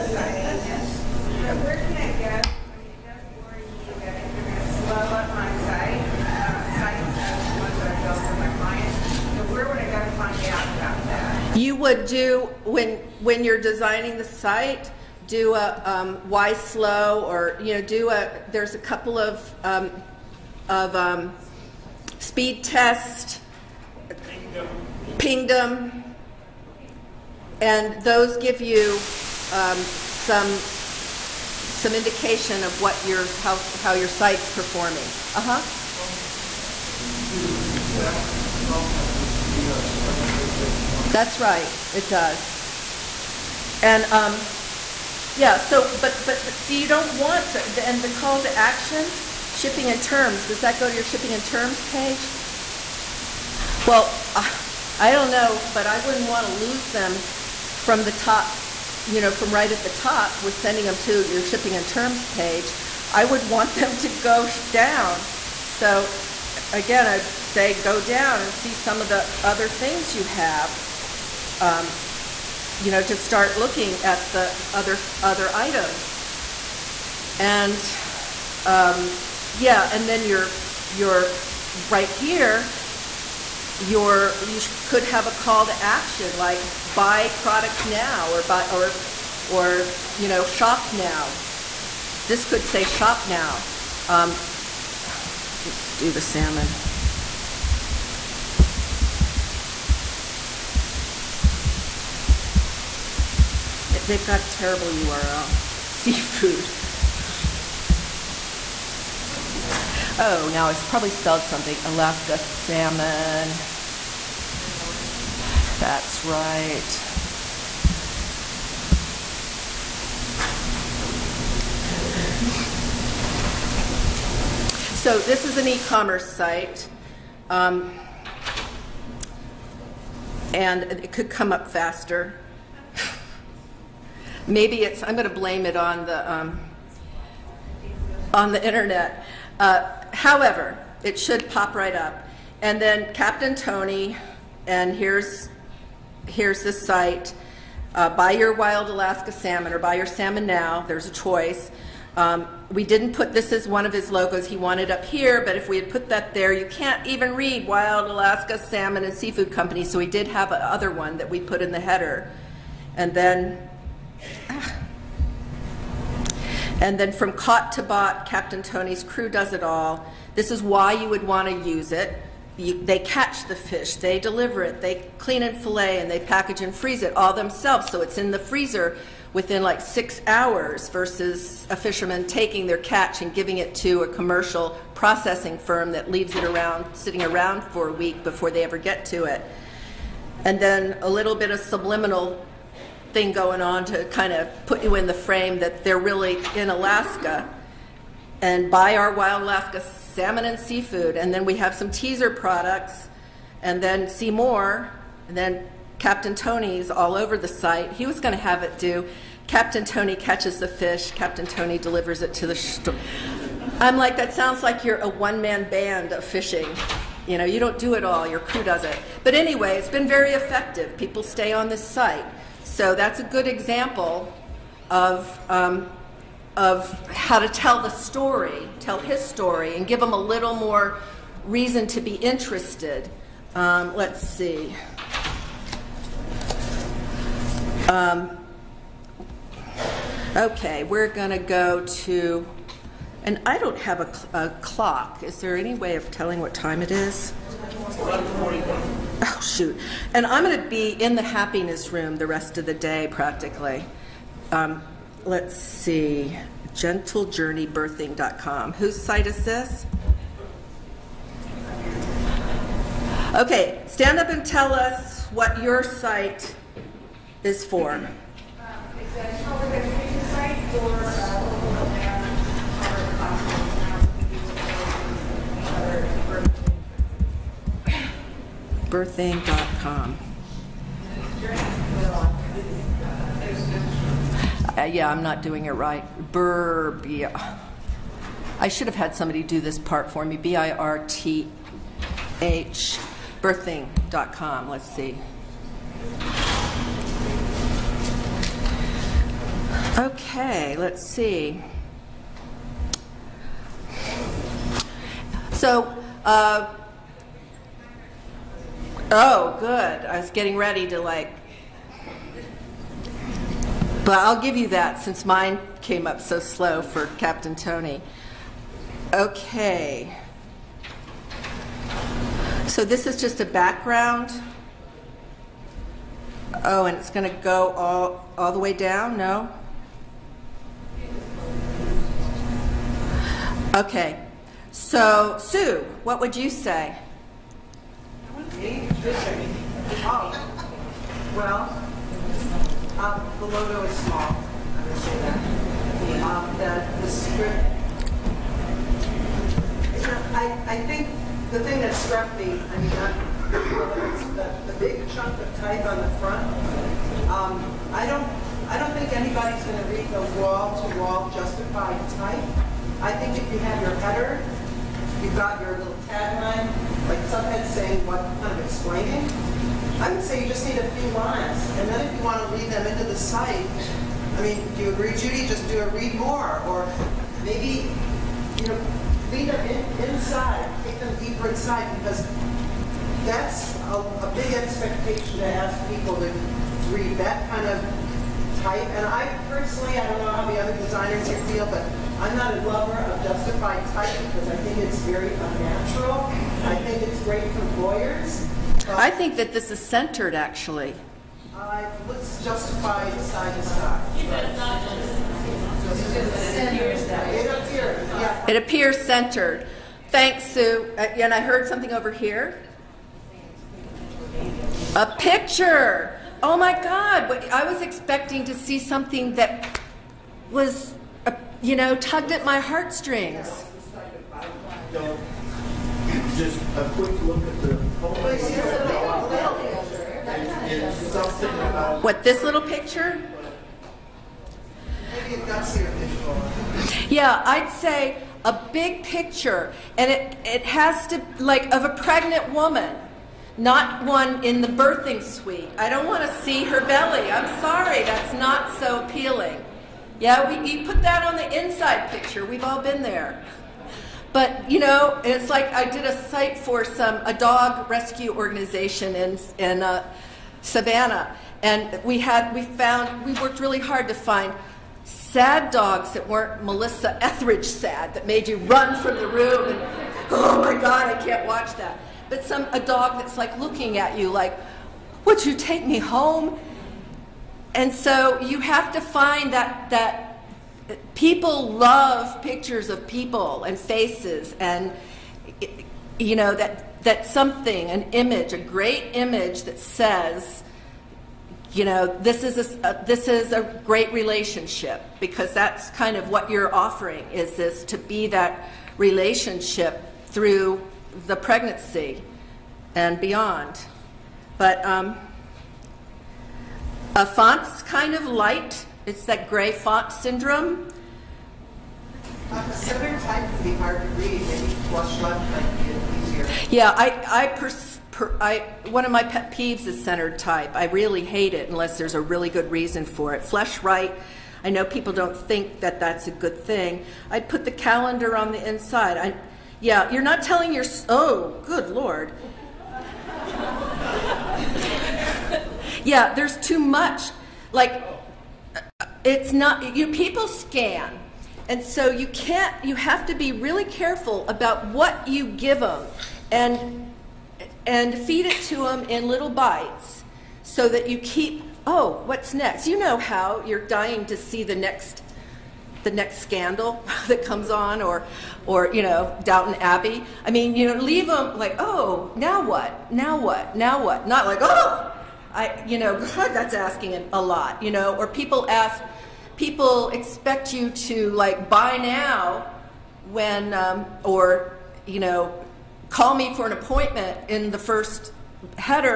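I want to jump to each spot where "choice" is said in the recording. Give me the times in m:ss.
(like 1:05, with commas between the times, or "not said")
2:31.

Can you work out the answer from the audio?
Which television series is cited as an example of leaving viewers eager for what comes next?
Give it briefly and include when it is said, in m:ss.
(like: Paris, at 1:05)
Downton Abbey, at 9:19.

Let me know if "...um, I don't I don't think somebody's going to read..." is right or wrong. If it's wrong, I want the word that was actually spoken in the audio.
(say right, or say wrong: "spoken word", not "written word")
wrong: "anybody", not "somebody".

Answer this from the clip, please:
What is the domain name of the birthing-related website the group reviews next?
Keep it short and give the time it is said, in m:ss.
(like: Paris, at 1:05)
gentlejourneybirthing.com, at 4:16.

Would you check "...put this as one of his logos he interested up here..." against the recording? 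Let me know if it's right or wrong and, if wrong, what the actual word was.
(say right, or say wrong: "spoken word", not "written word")
wrong: "wanted", not "interested".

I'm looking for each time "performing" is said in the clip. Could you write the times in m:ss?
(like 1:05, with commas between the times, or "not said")
0:34.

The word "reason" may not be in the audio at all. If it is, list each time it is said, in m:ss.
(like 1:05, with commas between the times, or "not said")
3:51, 8:42.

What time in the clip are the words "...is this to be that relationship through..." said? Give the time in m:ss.
8:17.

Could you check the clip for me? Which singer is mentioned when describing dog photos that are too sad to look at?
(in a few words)
Melissa Etheridge.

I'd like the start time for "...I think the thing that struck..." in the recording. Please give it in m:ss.
5:50.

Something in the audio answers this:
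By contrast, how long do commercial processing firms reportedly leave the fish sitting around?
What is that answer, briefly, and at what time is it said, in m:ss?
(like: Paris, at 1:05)
A week, at 3:07.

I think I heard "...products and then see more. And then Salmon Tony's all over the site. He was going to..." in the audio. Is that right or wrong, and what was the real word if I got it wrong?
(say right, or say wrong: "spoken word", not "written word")
wrong: "Captain", not "Salmon".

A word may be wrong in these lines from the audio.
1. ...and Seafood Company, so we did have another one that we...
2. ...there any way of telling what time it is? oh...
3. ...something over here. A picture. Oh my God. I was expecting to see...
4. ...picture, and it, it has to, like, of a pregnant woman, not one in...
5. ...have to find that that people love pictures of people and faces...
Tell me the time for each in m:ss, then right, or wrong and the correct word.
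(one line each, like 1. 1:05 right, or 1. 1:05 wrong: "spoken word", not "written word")
1. 2:39 right
2. 4:05 right
3. 6:51 right
4. 7:19 right
5. 7:58 right.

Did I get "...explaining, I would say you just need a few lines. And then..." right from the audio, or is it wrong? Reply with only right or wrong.
right.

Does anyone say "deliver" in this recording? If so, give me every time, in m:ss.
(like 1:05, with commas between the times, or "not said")
2:54, 3:31.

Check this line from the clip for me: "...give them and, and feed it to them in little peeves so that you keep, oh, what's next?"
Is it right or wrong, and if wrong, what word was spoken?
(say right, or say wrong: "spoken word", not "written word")
wrong: "bites", not "peeves".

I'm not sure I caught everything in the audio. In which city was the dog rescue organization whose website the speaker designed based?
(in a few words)
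Savannah.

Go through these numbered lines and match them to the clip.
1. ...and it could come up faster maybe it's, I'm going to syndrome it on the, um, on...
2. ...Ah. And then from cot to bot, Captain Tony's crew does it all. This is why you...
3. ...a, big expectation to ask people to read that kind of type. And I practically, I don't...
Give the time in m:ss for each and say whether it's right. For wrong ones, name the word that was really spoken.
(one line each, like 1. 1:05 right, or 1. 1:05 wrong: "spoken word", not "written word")
1. 2:10 wrong: "blame", not "syndrome"
2. 2:44 right
3. 6:24 wrong: "personally", not "practically".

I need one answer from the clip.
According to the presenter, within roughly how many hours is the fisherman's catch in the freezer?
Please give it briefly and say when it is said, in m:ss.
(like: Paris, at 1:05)
6 hours, at 2:59.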